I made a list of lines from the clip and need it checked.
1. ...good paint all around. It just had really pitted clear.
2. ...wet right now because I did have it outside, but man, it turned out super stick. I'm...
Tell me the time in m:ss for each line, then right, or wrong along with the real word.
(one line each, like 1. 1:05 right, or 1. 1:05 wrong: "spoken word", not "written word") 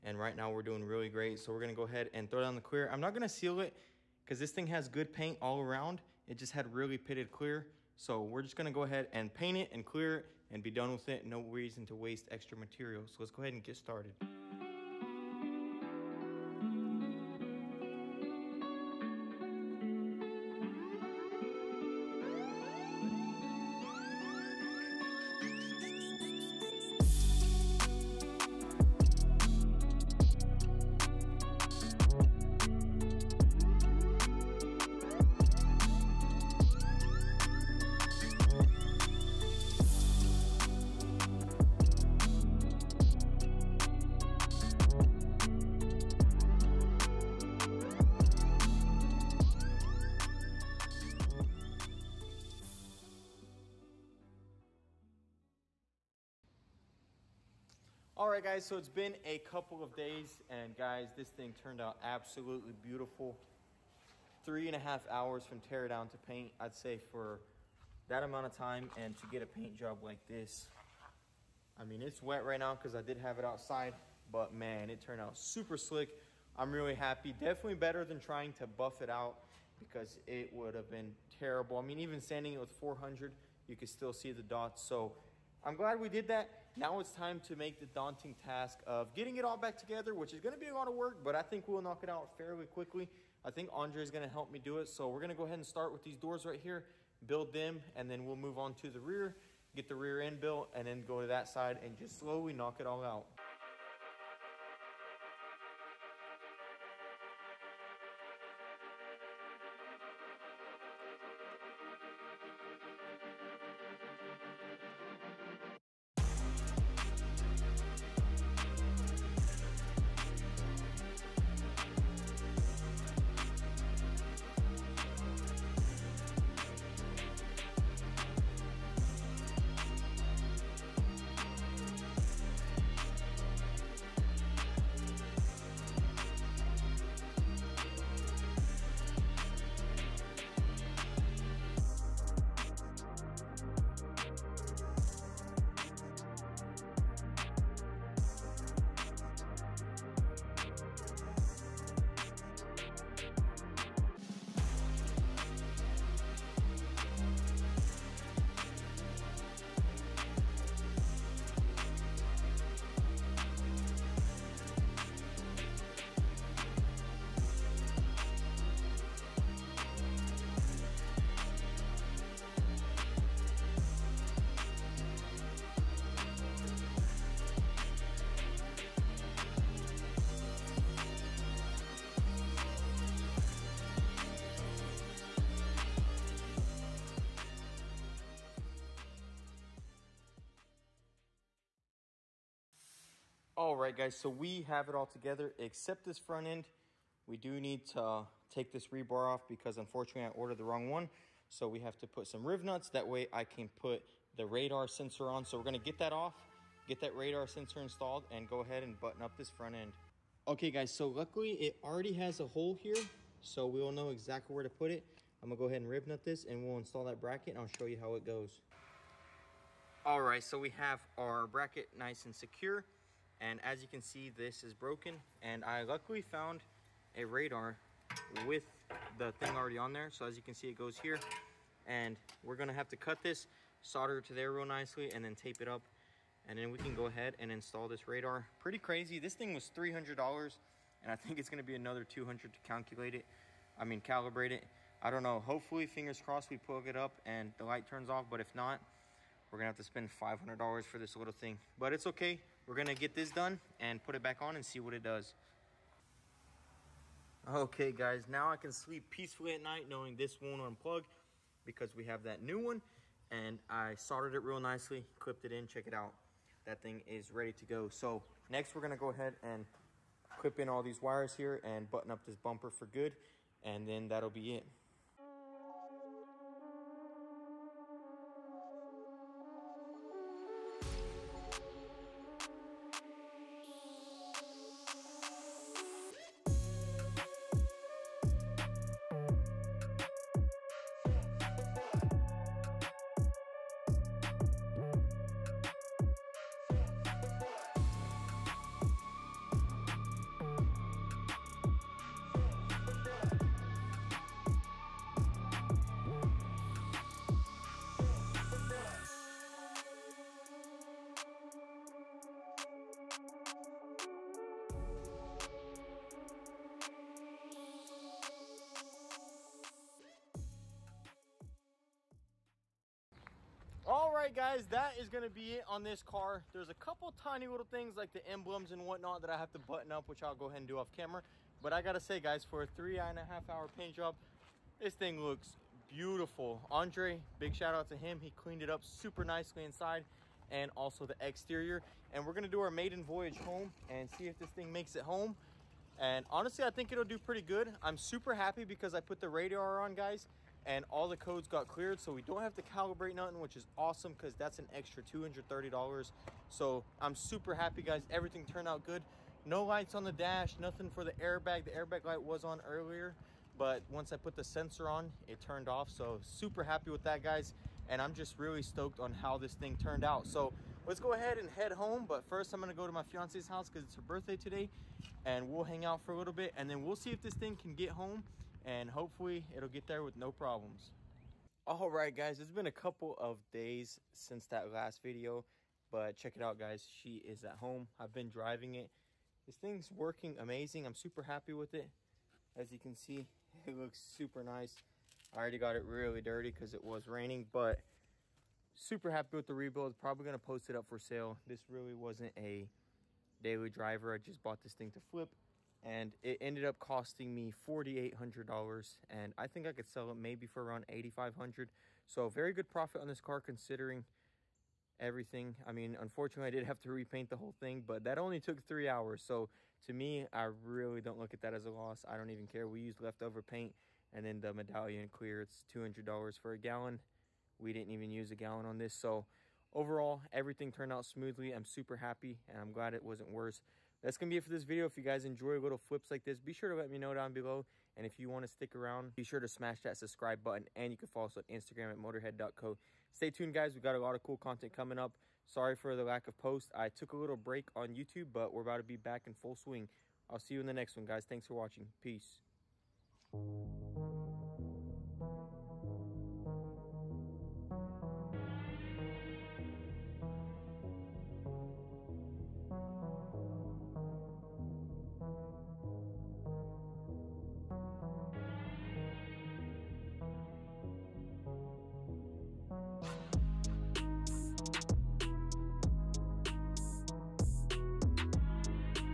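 1. 0:04 right
2. 1:12 wrong: "slick", not "stick".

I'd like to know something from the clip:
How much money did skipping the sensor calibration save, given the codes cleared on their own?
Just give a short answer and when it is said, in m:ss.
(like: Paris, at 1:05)
$230, at 5:55.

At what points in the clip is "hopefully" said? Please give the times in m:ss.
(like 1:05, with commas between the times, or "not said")
4:05, 6:18.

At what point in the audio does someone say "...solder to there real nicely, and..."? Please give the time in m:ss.
3:53.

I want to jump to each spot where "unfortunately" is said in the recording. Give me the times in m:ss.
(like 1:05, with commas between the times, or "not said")
3:19, 6:55.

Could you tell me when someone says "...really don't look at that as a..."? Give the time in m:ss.
7:00.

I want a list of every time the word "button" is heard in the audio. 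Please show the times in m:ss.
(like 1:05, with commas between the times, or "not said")
3:28, 4:31, 5:29, 7:20.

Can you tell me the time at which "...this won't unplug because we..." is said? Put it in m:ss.
4:20.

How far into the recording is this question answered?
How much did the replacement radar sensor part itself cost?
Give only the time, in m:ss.
3:59.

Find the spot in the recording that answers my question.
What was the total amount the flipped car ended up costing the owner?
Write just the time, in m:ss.
6:47.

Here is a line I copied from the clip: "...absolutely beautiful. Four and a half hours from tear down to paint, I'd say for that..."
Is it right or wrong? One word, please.
wrong.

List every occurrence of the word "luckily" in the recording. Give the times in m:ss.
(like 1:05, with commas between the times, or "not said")
3:31, 3:45.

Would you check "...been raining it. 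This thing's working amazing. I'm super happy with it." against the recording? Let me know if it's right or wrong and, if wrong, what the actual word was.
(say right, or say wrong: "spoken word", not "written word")
wrong: "driving", not "raining".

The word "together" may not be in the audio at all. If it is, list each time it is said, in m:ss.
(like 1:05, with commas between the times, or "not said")
1:29, 3:15.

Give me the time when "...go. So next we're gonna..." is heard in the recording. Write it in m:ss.
4:27.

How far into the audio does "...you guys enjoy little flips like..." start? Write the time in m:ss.
7:14.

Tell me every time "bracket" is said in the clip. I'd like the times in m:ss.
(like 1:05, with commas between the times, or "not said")
3:37, 3:41.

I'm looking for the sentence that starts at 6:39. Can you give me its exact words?
Probably going to post it up for sale.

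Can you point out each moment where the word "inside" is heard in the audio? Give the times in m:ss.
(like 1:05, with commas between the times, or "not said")
5:39.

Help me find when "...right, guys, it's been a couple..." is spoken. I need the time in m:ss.
6:21.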